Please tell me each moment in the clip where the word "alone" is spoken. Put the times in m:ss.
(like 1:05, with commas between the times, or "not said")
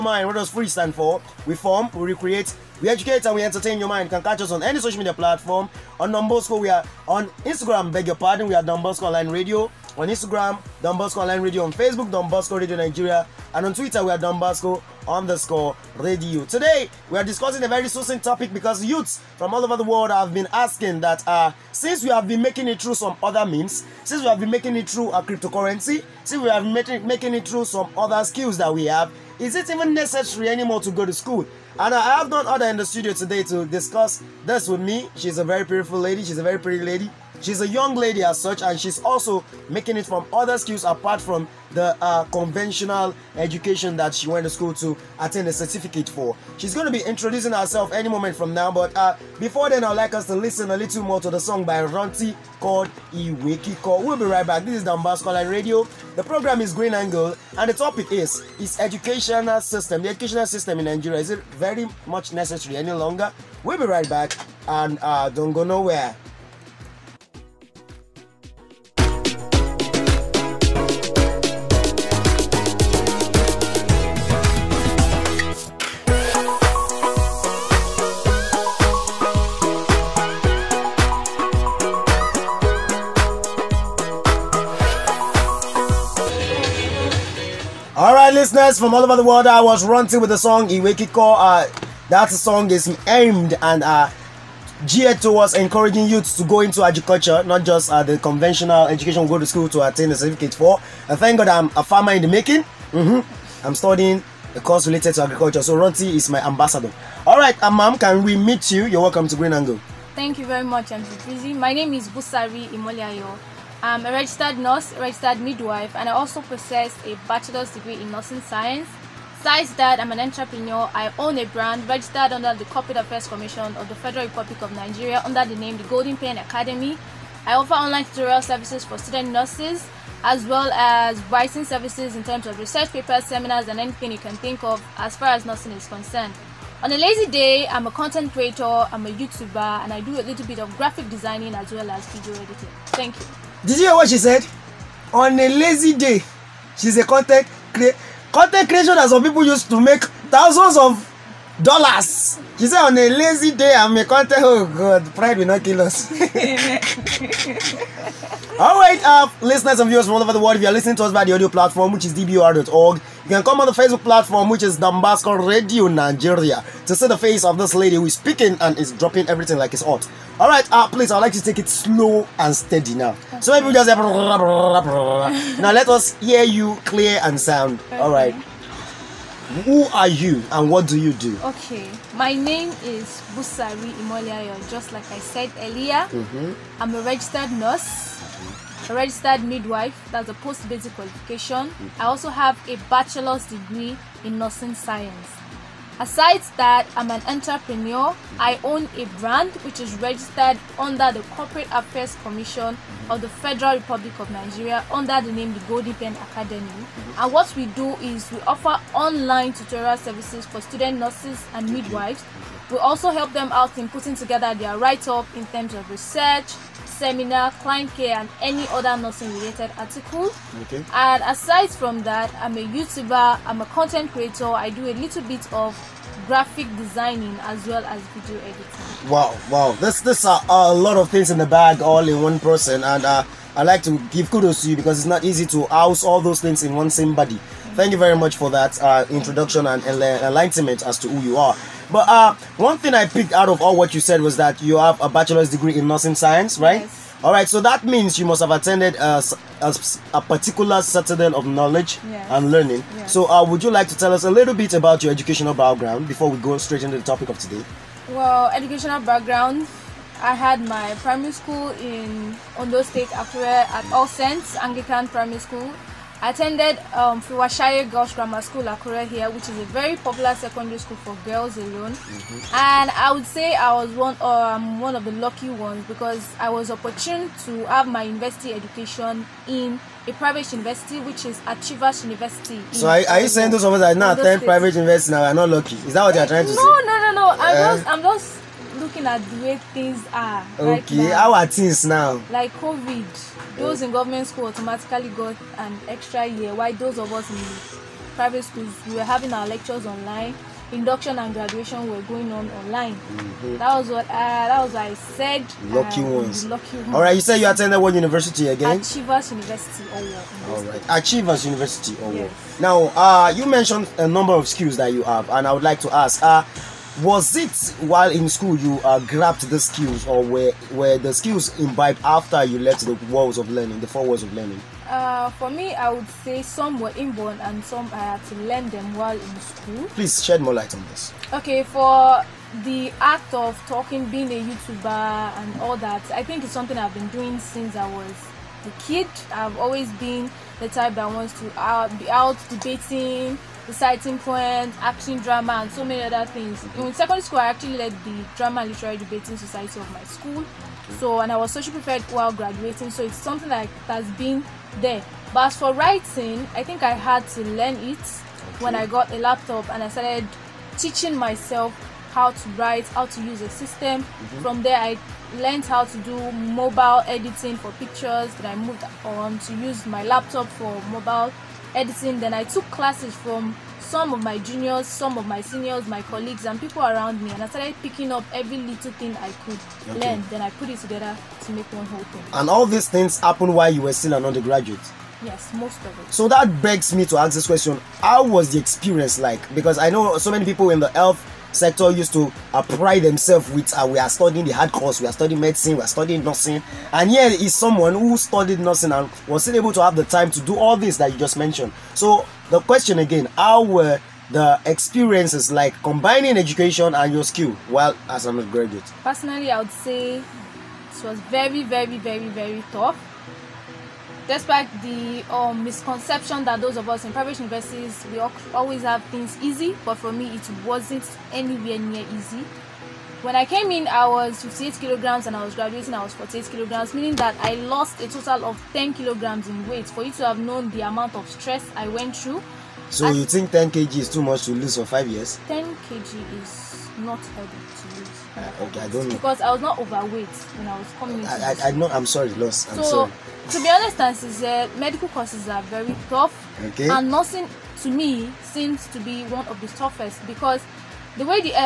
4:31.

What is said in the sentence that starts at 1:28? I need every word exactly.
listeners from all over the world, I was ranting with the song Iwekiko.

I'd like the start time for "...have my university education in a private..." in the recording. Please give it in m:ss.
4:37.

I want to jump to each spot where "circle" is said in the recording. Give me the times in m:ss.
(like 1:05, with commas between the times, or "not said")
not said.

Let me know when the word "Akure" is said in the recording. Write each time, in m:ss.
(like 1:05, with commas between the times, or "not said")
4:23, 4:28.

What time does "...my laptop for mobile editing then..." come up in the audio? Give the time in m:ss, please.
6:09.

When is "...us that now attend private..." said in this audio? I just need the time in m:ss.
4:43.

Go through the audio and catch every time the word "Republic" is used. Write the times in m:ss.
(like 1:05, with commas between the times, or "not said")
2:04, 3:23.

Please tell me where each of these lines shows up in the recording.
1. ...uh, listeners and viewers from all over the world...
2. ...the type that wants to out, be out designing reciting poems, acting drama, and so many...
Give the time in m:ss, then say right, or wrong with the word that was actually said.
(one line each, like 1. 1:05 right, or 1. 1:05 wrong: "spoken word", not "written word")
1. 2:39 right
2. 5:40 wrong: "debating", not "designing".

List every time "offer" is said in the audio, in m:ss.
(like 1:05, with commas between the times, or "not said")
2:07, 3:28.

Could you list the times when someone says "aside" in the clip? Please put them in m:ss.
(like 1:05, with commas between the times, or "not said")
3:16, 3:41.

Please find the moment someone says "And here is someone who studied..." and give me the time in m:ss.
6:36.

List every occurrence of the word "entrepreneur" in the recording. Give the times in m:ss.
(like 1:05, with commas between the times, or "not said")
2:00, 3:17.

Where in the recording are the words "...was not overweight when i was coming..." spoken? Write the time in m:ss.
7:19.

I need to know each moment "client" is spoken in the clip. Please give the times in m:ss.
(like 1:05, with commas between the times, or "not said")
3:37.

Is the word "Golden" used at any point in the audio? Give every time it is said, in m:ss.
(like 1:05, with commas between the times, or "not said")
2:05, 3:25.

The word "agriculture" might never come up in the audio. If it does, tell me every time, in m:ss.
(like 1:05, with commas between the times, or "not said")
1:36, 1:45.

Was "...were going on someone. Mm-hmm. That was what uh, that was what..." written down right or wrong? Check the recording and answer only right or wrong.
wrong.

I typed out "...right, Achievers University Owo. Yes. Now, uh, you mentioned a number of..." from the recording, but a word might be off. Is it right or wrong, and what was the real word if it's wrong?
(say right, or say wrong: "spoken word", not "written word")
right.